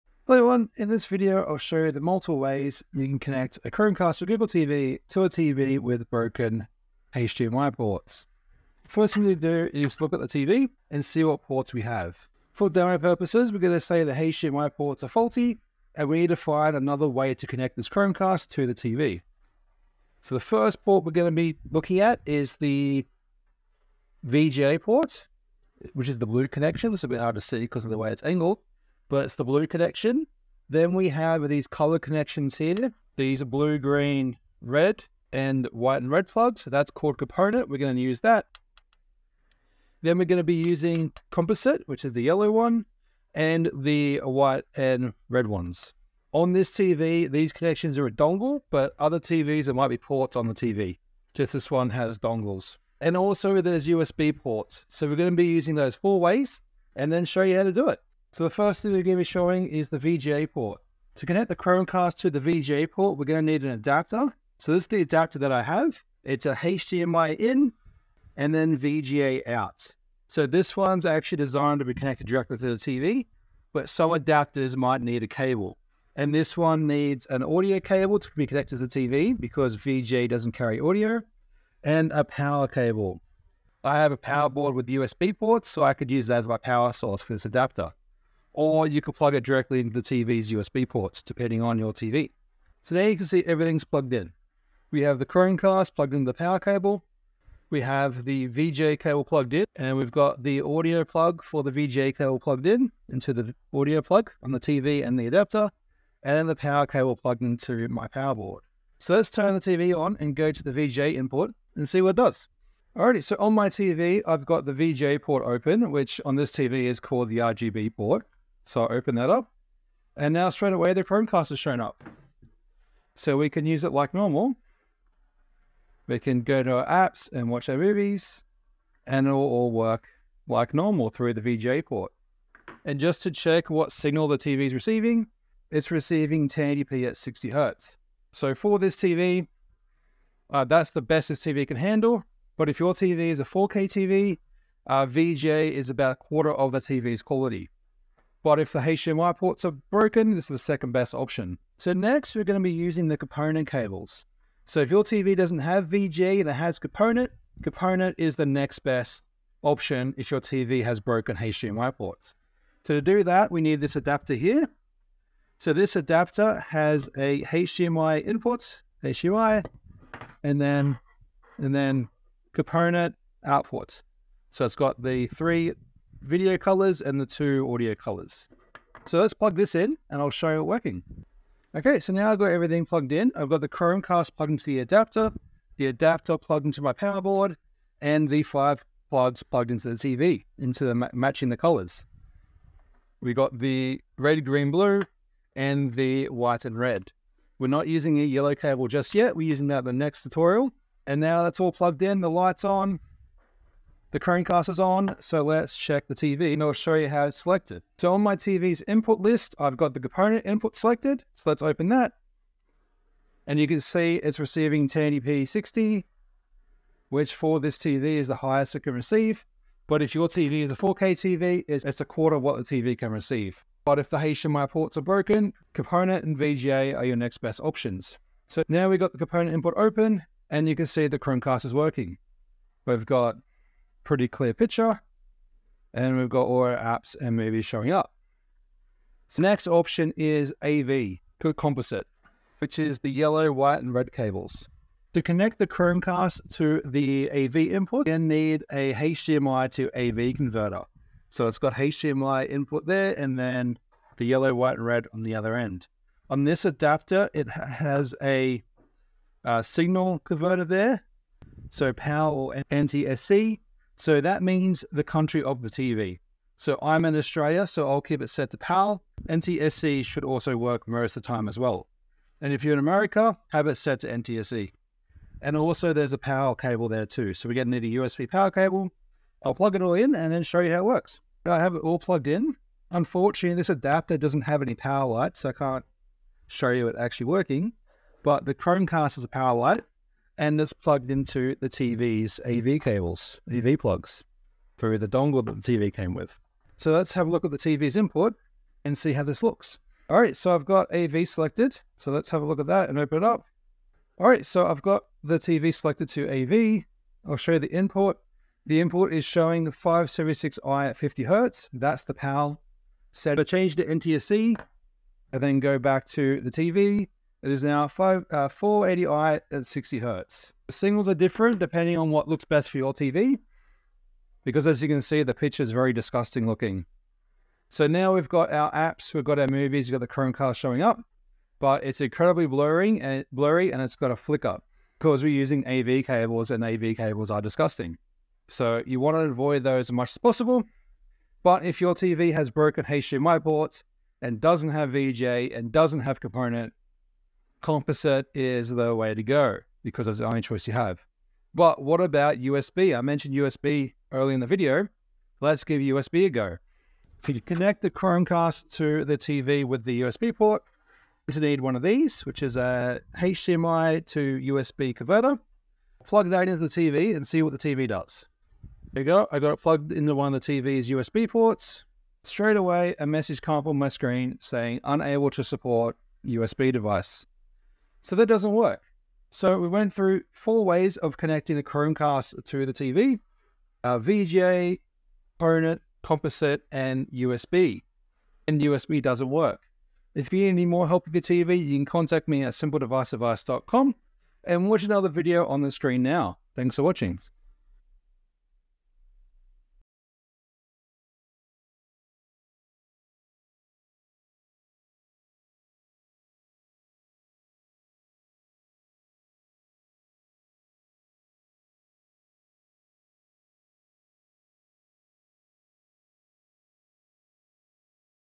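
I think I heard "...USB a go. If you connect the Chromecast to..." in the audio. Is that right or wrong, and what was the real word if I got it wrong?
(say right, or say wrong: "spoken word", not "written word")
right.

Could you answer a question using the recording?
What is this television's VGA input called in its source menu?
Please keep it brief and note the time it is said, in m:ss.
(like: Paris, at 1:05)
RGB port, at 1:57.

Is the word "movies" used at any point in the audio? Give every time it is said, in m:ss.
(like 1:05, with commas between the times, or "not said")
2:07, 3:57, 5:29.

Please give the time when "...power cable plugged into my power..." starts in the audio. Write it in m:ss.
1:46.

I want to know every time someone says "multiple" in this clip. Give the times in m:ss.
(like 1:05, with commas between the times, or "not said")
0:01.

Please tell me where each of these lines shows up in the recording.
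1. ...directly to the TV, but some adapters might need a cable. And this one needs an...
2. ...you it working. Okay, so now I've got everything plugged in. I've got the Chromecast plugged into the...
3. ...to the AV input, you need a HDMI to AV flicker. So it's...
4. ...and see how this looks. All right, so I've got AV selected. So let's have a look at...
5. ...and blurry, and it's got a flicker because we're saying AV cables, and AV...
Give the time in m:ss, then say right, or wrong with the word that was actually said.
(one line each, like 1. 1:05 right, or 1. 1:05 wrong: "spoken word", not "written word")
1. 1:12 right
2. 3:00 right
3. 4:06 wrong: "converter", not "flicker"
4. 4:58 right
5. 5:33 wrong: "using", not "saying".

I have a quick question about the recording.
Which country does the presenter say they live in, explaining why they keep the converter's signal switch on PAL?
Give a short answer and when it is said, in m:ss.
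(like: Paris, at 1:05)
Australia, at 4:27.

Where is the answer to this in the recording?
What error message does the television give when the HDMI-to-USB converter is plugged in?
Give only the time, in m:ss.
6:14.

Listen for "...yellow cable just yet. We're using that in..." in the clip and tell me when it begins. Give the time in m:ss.
3:18.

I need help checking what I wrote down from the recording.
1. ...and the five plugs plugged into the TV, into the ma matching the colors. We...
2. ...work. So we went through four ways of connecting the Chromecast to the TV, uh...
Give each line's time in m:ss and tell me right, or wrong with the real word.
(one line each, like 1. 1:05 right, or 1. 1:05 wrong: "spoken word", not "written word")
1. 3:08 right
2. 6:18 right.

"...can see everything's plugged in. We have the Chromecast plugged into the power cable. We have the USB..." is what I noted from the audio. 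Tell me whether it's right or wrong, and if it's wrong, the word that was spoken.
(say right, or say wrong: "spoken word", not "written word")
wrong: "VGA", not "USB".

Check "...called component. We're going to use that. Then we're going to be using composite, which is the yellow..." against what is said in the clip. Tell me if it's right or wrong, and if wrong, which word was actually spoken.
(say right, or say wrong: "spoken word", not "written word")
right.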